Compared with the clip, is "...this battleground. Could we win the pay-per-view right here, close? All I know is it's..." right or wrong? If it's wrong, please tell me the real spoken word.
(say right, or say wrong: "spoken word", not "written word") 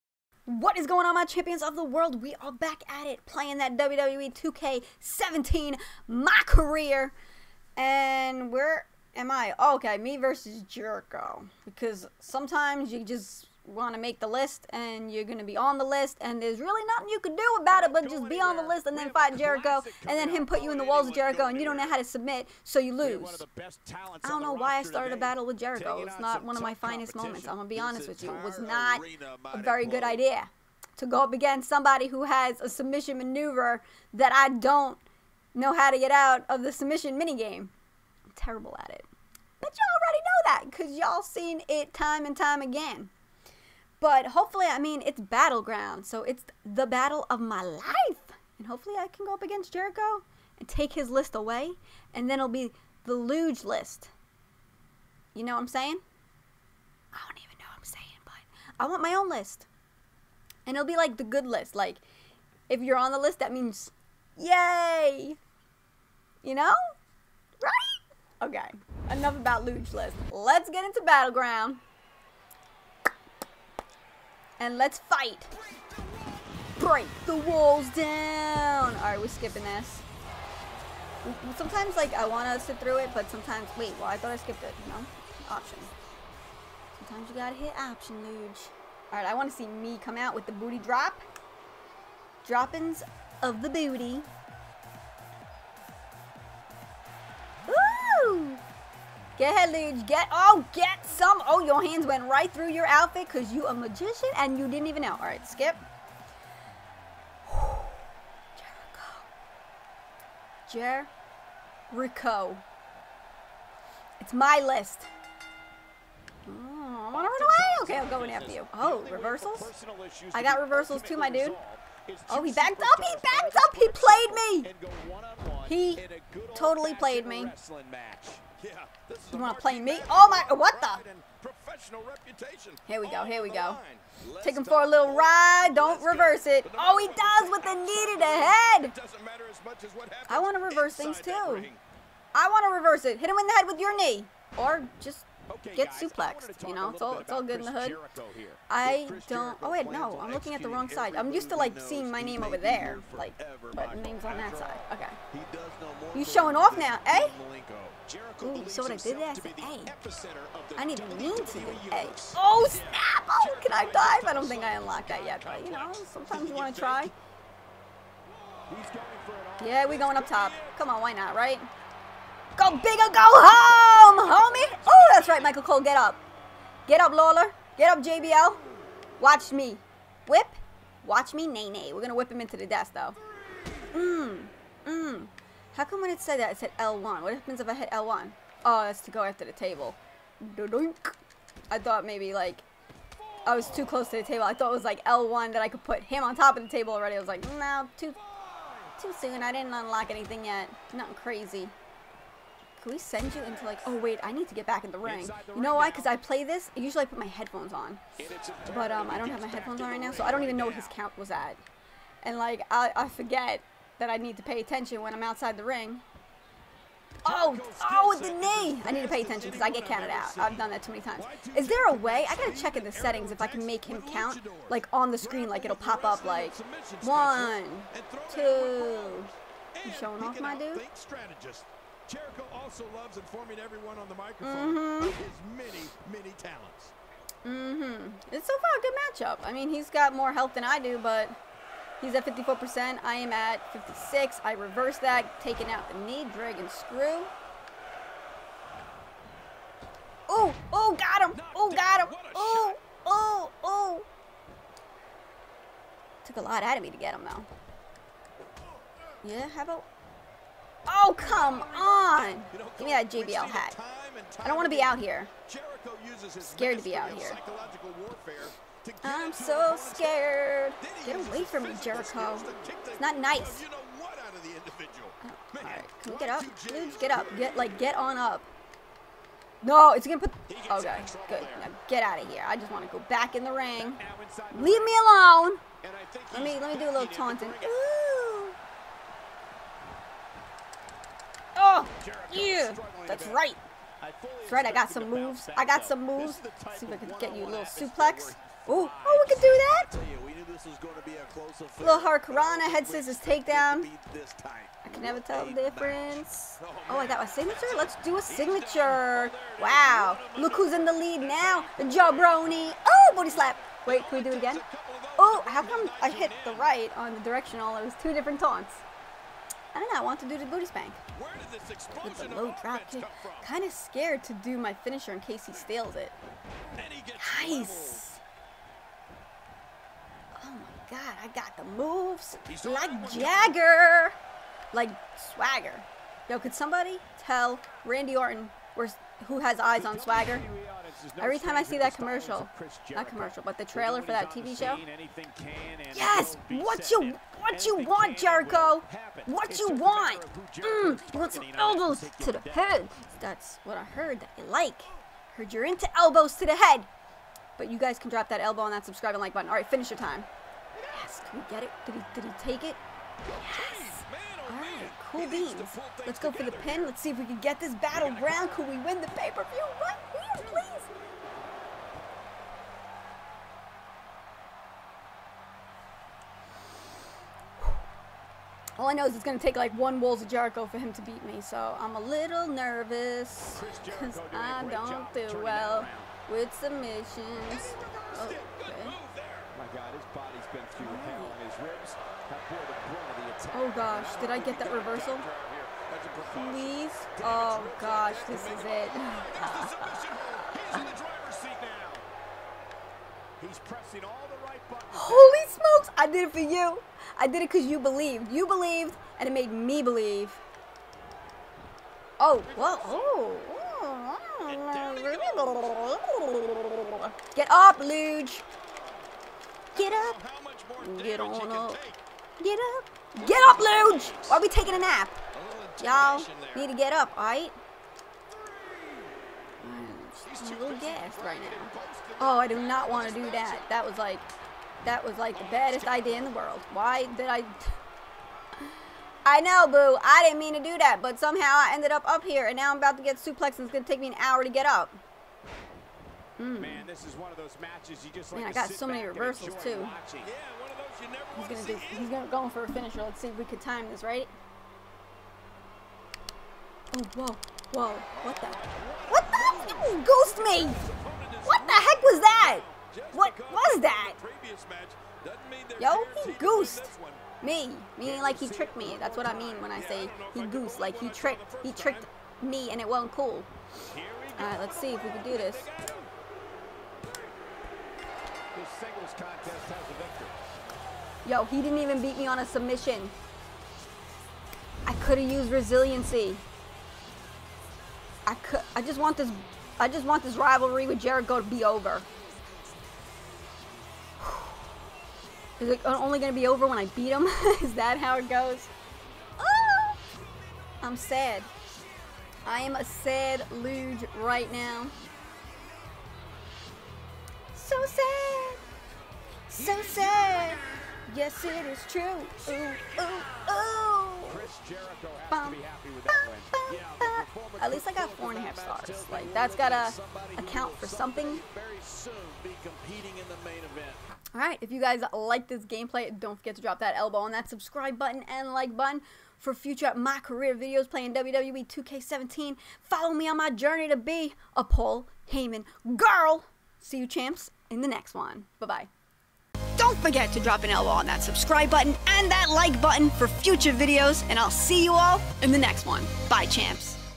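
wrong: "please", not "close".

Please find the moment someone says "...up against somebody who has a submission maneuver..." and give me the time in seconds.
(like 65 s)
31 s.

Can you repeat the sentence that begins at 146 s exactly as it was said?
You know, it's all it's all good in the hood.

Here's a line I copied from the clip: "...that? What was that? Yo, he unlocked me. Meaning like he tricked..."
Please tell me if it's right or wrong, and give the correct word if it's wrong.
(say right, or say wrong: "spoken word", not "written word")
wrong: "goosed", not "unlocked".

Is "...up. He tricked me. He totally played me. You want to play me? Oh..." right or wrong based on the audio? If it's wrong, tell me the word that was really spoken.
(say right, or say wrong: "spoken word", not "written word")
wrong: "played", not "tricked".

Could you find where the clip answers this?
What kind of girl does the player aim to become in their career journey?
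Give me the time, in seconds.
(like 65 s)
534 s.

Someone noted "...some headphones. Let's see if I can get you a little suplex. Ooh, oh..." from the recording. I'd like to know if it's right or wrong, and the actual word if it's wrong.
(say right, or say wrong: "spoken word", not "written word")
wrong: "moves", not "headphones".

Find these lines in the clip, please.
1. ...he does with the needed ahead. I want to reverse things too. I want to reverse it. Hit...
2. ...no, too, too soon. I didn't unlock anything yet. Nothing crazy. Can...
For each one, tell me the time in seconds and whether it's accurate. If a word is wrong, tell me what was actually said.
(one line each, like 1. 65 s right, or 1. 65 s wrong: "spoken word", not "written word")
1. 136 s right
2. 197 s right.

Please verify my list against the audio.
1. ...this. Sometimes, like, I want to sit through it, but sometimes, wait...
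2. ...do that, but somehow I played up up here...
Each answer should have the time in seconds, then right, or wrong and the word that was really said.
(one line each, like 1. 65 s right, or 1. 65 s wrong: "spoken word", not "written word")
1. 79 s right
2. 440 s wrong: "ended", not "played".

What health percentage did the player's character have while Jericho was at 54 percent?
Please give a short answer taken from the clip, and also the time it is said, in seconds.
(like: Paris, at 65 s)
56, at 243 s.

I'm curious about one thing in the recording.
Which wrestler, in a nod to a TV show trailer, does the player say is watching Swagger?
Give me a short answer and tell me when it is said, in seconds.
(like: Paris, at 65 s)
Randy Orton, at 337 s.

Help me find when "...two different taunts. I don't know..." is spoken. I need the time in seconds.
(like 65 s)
318 s.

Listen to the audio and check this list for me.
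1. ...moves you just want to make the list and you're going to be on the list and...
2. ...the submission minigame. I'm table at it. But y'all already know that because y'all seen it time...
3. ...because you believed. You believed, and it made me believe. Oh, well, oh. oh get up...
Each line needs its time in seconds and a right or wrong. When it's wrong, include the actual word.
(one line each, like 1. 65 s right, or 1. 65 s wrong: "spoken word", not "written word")
1. 12 s wrong: "sometimes", not "moves"
2. 36 s wrong: "terrible", not "table"
3. 407 s right.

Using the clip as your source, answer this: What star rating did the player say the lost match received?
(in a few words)
4.5 stars.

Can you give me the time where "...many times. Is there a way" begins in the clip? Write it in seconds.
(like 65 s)
220 s.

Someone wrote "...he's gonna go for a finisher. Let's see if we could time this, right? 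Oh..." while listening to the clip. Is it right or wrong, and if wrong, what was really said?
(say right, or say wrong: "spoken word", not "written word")
right.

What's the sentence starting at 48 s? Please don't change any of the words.
And hopefully, I can go up against Jericho and take his list away, and then it'll be the luge list.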